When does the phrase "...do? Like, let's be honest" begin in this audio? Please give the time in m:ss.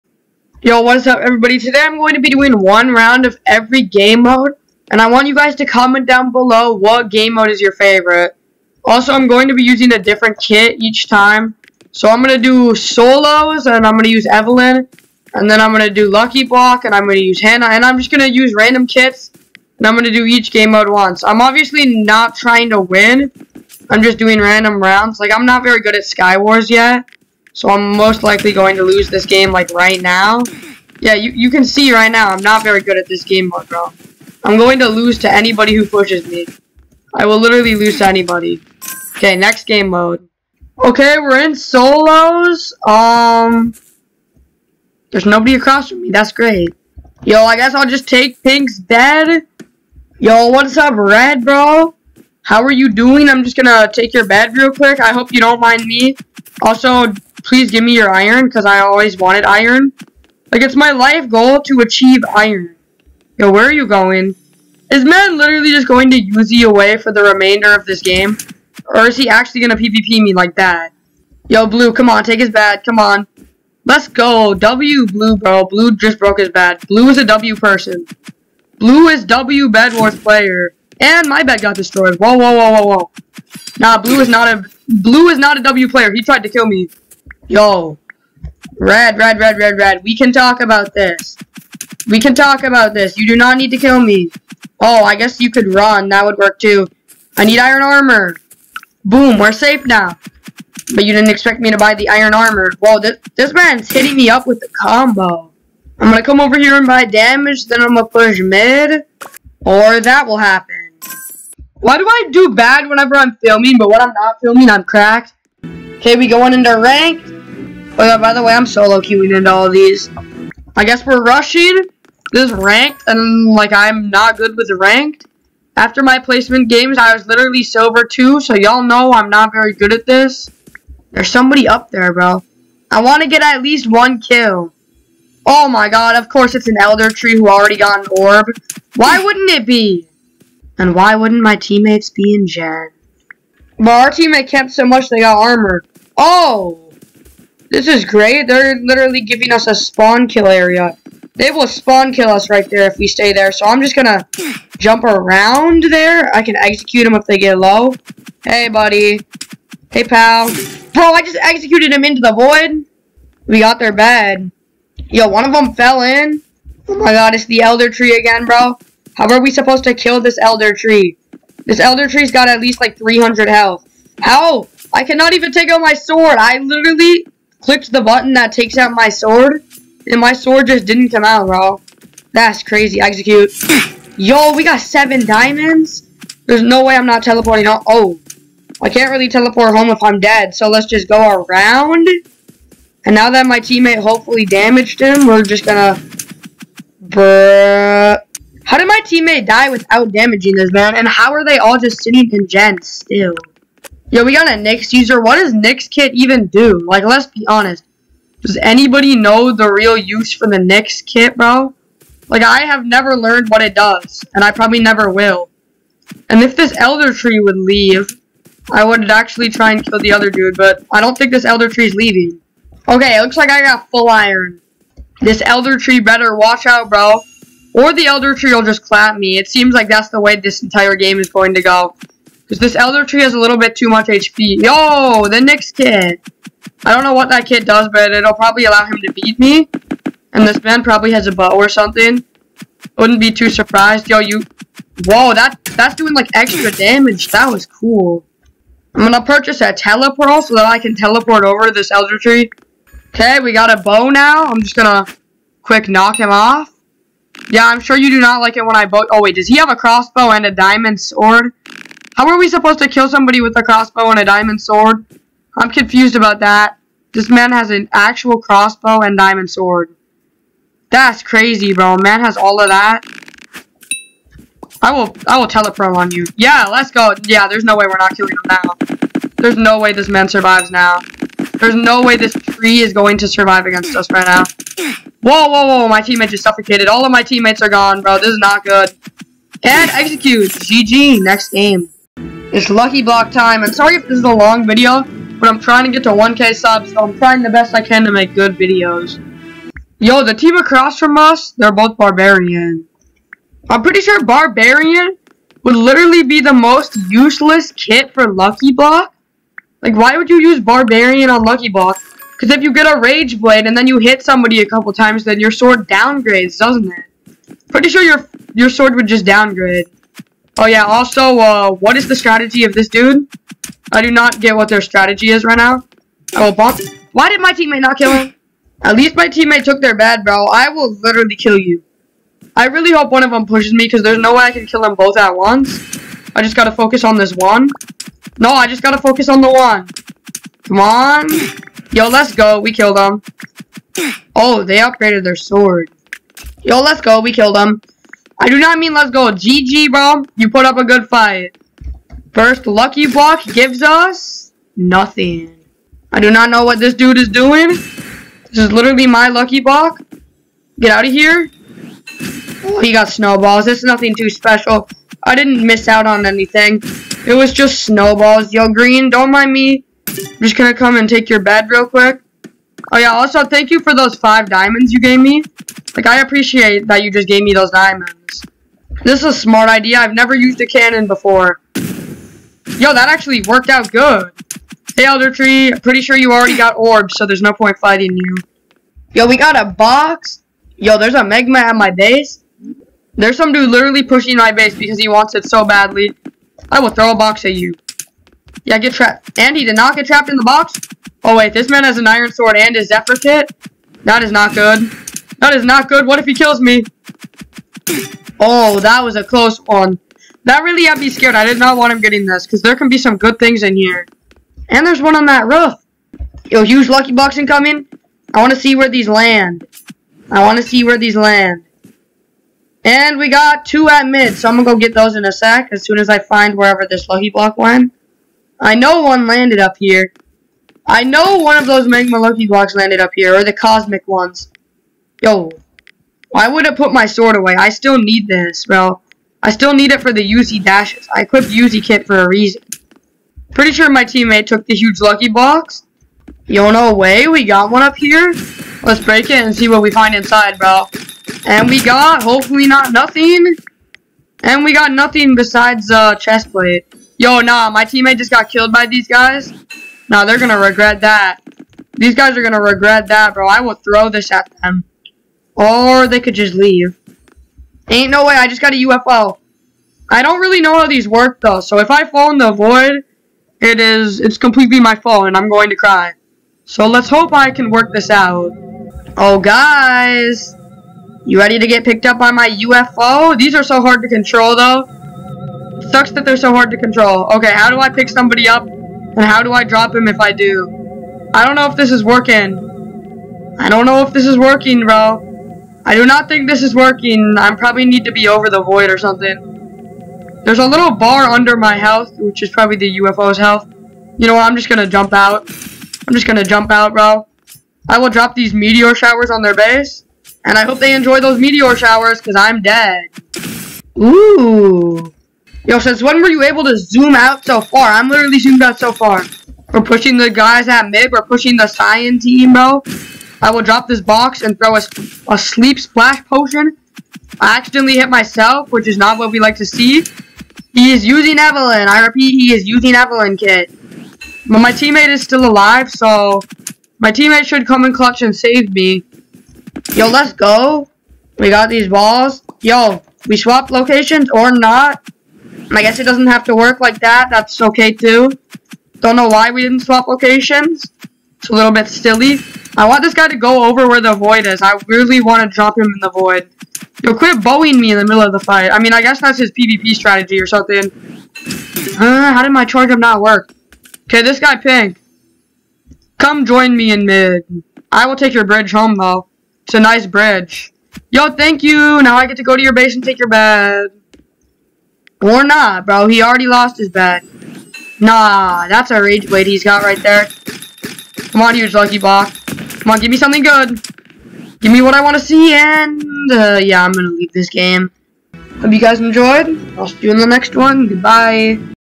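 3:26.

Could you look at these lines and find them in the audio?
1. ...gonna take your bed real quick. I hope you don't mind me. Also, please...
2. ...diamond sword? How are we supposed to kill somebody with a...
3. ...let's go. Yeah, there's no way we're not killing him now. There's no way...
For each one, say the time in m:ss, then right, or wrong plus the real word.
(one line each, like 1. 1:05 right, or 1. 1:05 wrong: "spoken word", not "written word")
1. 0:53 right
2. 4:20 right
3. 4:36 right.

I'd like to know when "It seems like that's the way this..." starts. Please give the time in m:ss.
3:49.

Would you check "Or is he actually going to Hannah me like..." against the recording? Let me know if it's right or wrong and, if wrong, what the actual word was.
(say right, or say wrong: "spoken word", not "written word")
wrong: "PvP", not "Hannah".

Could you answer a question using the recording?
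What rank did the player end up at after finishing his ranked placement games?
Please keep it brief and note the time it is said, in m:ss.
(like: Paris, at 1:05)
Silver, at 2:07.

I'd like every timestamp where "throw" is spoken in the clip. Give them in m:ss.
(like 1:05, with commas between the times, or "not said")
6:36, 7:43, 8:44.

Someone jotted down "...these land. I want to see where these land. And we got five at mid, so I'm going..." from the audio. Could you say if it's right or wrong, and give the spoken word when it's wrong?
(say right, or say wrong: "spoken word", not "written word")
wrong: "two", not "five".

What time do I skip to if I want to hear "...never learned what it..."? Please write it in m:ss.
3:32.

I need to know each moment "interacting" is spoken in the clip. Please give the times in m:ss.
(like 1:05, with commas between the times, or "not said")
not said.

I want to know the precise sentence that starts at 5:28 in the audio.
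At least my teammate took their bad, bro.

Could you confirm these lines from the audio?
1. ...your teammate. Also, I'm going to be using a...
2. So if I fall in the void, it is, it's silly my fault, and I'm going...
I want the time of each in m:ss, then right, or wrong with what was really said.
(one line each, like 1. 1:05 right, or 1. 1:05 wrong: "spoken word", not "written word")
1. 0:07 wrong: "favorite", not "teammate"
2. 7:51 wrong: "completely", not "silly".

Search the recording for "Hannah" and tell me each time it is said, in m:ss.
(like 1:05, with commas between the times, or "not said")
0:17.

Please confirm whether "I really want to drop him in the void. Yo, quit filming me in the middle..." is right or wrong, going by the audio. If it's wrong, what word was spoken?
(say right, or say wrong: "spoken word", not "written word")
wrong: "bowing", not "filming".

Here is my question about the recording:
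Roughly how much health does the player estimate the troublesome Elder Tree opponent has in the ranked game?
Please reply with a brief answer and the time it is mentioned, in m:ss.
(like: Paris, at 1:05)
300, at 2:52.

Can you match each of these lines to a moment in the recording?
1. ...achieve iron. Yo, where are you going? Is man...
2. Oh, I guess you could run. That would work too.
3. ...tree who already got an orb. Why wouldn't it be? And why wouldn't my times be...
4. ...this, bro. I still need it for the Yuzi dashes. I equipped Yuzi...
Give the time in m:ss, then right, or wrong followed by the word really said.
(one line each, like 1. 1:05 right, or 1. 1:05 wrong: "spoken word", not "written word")
1. 1:01 right
2. 1:34 right
3. 2:17 wrong: "teammates", not "times"
4. 7:18 right.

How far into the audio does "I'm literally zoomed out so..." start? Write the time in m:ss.
8:37.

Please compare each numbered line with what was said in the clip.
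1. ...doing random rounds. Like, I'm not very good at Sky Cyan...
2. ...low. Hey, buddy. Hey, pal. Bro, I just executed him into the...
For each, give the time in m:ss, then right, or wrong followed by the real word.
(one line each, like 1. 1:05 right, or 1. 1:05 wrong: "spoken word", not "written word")
1. 0:24 wrong: "Wars", not "Cyan"
2. 2:37 right.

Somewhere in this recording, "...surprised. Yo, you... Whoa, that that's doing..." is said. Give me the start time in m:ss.
4:03.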